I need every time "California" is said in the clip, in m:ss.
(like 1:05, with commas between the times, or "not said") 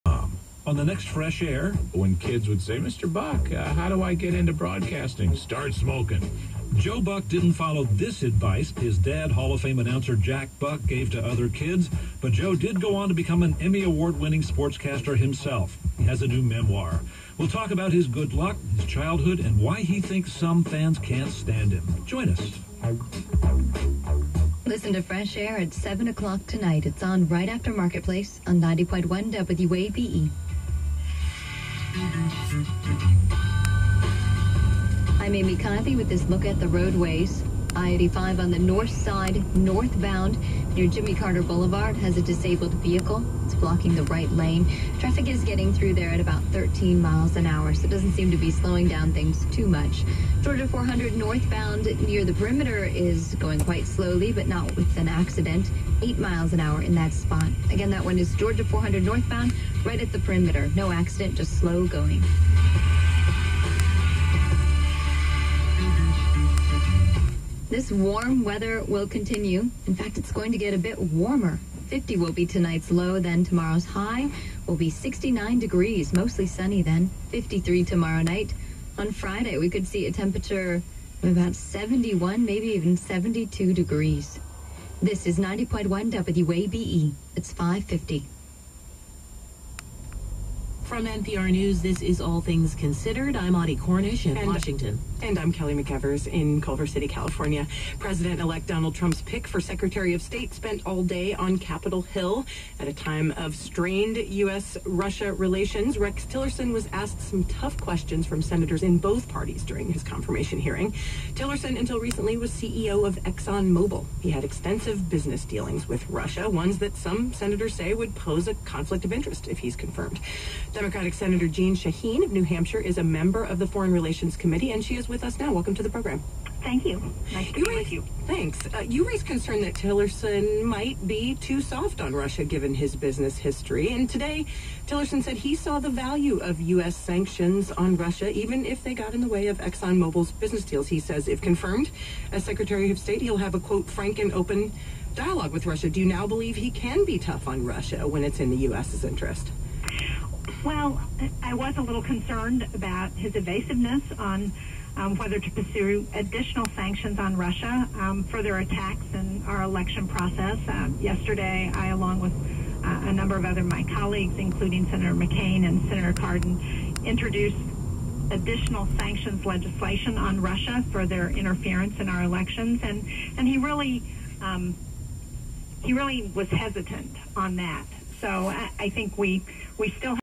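1:37.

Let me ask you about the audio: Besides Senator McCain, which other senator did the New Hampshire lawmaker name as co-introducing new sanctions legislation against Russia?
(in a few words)
Senator Cardin.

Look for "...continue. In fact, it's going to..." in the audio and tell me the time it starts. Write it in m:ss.
1:09.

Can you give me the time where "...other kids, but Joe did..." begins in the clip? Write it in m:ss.
0:11.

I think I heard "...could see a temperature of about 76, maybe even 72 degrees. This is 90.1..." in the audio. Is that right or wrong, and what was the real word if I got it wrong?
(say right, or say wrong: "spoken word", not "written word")
wrong: "71", not "76".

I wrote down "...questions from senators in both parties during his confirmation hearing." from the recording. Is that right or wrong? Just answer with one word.
right.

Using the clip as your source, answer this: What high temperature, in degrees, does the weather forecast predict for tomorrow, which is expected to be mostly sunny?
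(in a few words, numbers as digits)
69.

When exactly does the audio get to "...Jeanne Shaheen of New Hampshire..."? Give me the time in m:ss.
2:01.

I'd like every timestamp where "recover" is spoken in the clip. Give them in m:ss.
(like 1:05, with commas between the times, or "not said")
not said.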